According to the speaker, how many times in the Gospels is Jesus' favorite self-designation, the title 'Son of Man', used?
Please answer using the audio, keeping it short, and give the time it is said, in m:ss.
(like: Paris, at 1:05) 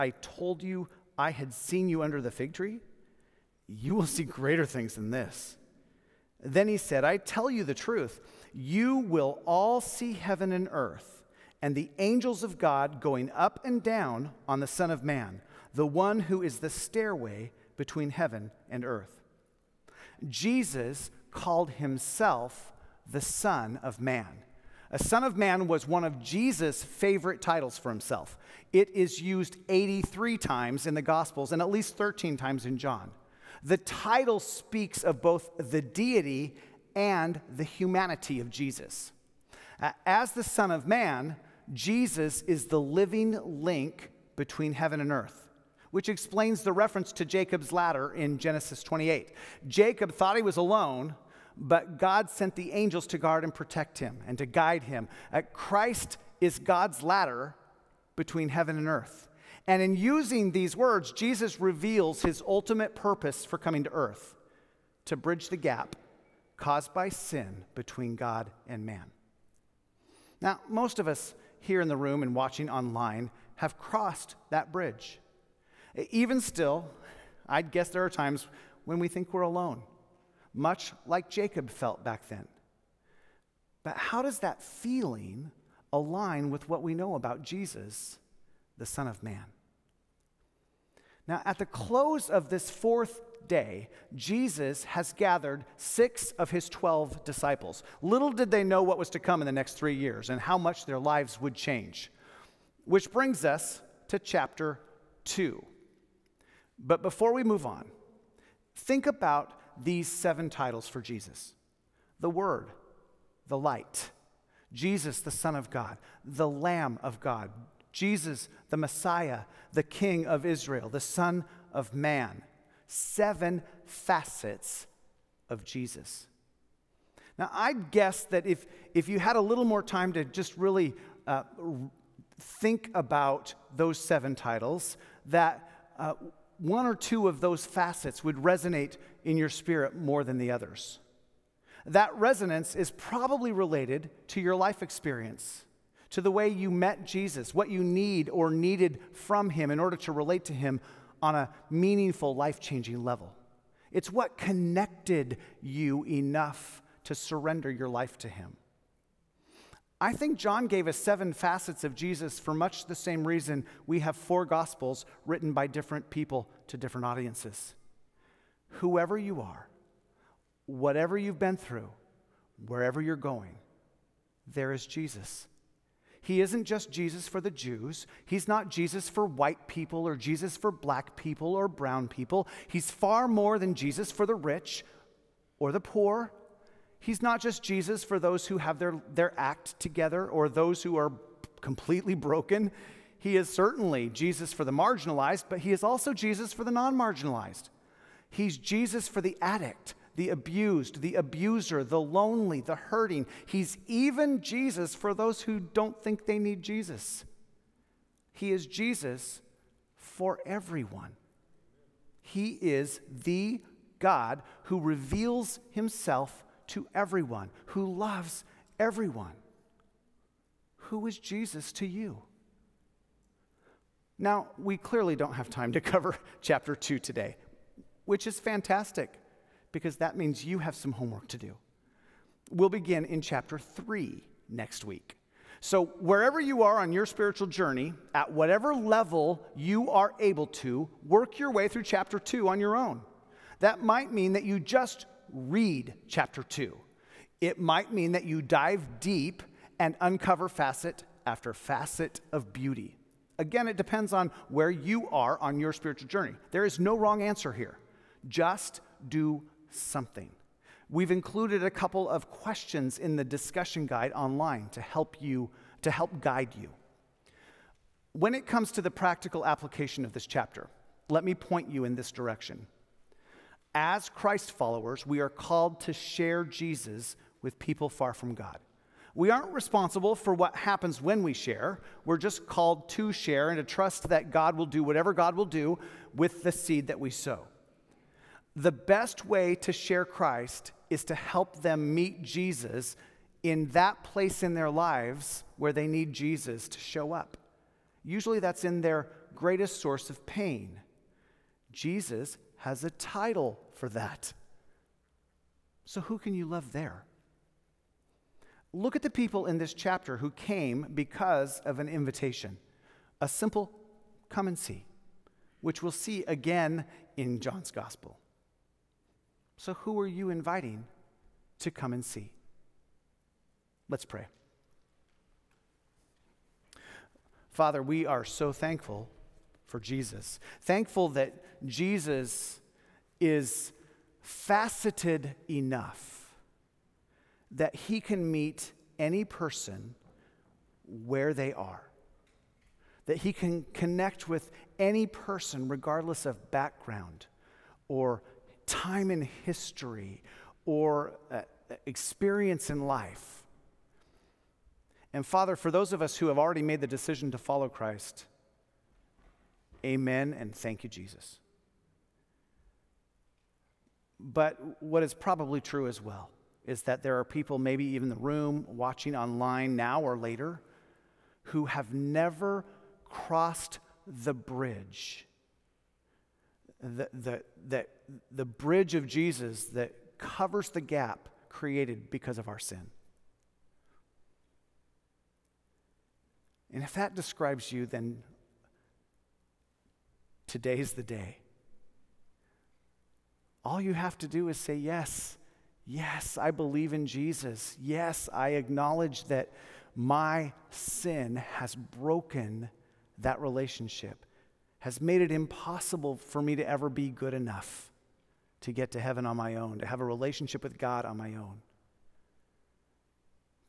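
83, at 0:29.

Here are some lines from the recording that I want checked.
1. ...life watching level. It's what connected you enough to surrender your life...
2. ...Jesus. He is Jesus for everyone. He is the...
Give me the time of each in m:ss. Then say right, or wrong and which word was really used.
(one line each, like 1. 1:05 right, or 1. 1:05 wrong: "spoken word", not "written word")
1. 2:32 wrong: "changing", not "watching"
2. 3:26 right.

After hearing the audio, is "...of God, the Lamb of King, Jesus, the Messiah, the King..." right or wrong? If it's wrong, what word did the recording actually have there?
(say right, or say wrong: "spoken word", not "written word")
wrong: "God", not "King".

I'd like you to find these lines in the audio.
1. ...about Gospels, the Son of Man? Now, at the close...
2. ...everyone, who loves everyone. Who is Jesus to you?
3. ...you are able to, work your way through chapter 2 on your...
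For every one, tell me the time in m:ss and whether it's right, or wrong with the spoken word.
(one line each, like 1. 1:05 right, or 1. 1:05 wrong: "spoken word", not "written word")
1. 1:27 wrong: "Jesus", not "Gospels"
2. 3:36 right
3. 3:59 right.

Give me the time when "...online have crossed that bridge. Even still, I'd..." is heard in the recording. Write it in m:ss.
1:12.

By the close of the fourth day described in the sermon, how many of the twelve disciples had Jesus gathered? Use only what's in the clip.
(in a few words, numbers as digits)
6.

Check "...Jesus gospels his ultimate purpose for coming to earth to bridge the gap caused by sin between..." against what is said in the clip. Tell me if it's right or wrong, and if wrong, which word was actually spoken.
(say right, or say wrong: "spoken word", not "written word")
wrong: "reveals", not "gospels".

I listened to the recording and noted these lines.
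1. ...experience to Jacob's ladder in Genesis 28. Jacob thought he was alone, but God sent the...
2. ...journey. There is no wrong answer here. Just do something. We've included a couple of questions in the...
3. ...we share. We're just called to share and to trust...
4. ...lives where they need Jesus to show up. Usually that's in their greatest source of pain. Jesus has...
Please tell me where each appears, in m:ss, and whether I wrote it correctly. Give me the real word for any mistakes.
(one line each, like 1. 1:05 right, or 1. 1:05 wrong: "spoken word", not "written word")
1. 0:46 wrong: "reference", not "experience"
2. 4:16 right
3. 4:41 right
4. 4:54 right.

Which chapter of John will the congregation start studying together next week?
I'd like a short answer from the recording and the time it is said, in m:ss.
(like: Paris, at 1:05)
Chapter 3, at 3:53.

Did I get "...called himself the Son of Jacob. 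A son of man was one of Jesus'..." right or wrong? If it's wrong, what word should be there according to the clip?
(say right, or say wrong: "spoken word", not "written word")
wrong: "Man", not "Jacob".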